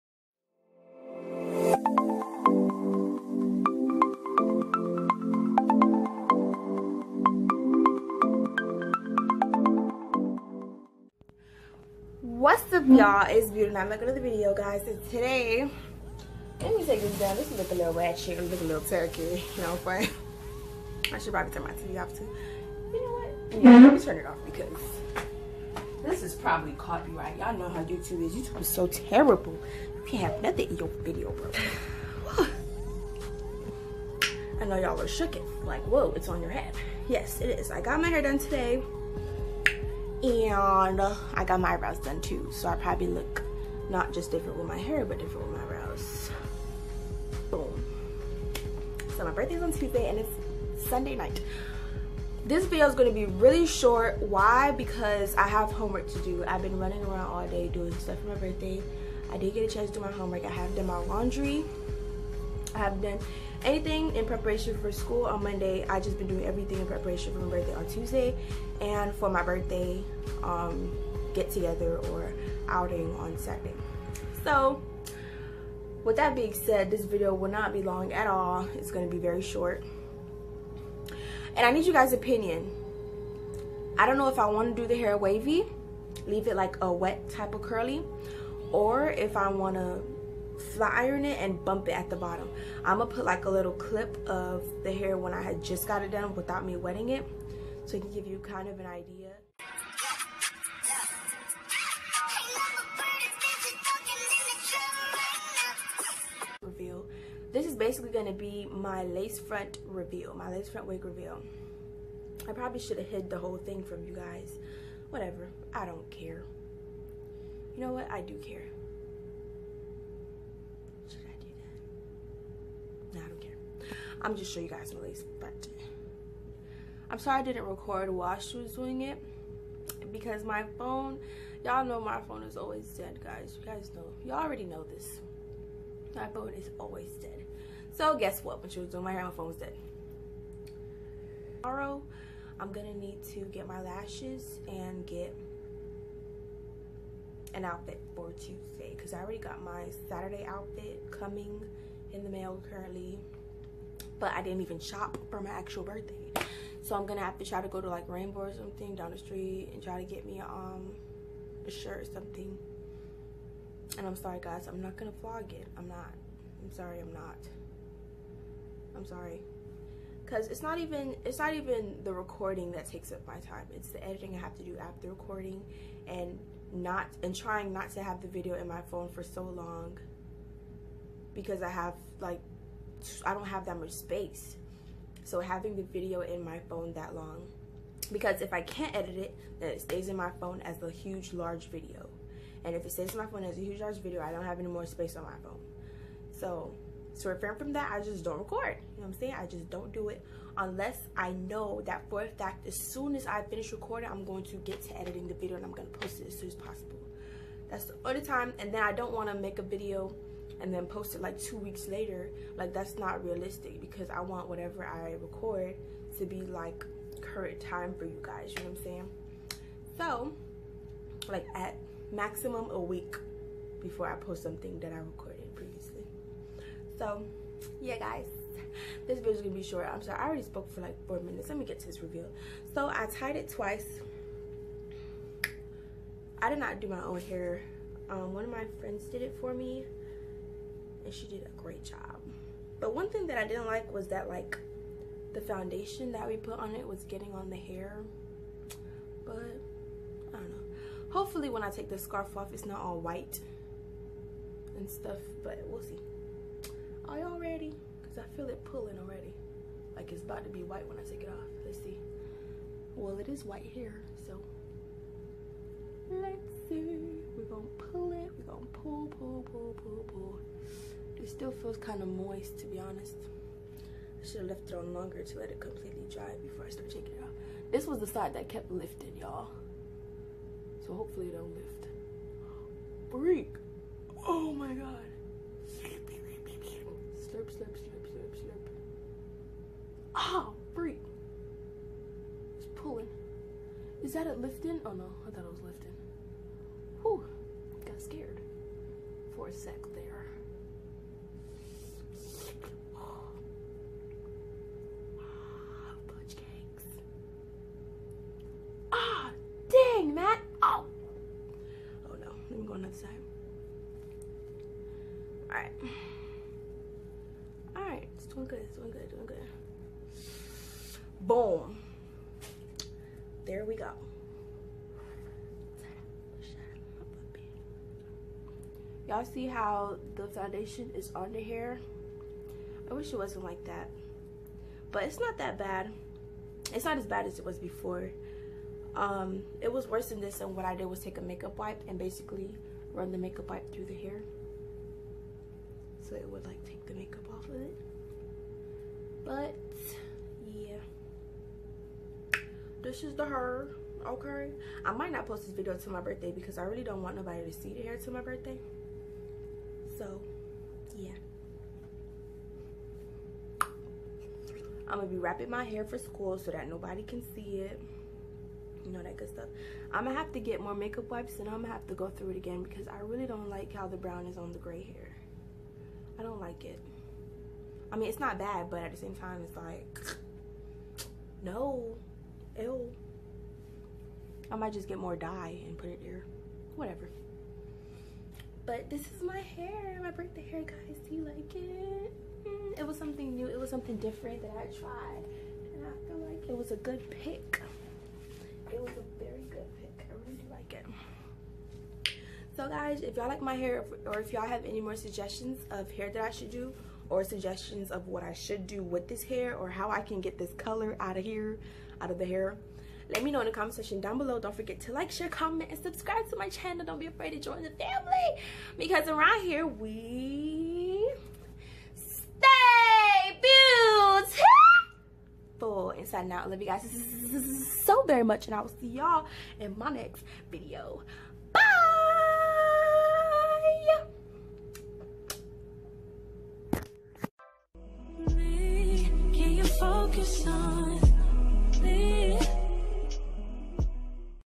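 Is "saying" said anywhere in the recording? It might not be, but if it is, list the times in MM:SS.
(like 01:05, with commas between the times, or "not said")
03:19, 03:38.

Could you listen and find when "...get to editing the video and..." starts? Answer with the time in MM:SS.
03:24.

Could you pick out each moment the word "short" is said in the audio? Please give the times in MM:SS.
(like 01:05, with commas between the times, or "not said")
00:53, 01:19, 03:49.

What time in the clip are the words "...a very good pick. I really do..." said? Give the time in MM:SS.
06:38.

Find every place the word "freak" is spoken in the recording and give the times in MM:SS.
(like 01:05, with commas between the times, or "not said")
04:43, 04:50.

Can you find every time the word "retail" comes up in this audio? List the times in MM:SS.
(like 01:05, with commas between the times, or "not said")
not said.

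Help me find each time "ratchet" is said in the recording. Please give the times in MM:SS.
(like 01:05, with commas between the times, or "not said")
00:17.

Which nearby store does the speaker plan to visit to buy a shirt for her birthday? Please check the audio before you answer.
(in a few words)
Rainbow.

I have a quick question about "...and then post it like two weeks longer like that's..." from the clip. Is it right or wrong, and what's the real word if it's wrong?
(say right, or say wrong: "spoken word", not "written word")
wrong: "later", not "longer".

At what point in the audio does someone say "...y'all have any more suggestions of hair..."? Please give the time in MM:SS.
06:44.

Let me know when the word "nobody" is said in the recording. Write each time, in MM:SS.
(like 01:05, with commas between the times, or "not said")
05:57, 06:06.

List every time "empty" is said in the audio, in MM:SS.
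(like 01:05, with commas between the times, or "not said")
not said.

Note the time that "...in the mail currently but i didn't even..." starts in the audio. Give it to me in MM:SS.
02:32.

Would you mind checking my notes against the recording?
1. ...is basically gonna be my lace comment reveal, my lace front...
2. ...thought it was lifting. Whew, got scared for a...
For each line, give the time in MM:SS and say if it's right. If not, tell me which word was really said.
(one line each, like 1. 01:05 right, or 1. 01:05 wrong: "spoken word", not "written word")
1. 01:47 wrong: "front", not "comment"
2. 04:55 right.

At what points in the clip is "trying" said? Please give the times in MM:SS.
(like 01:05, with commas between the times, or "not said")
02:57.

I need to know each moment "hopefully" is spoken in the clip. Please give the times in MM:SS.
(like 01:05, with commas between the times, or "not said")
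04:11, 04:40.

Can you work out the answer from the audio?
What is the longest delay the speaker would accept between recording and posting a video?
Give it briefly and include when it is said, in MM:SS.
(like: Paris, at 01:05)
A week, at 03:42.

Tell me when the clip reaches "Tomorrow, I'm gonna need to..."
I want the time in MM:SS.
02:21.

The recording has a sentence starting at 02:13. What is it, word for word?
You guys know, y'all already know this.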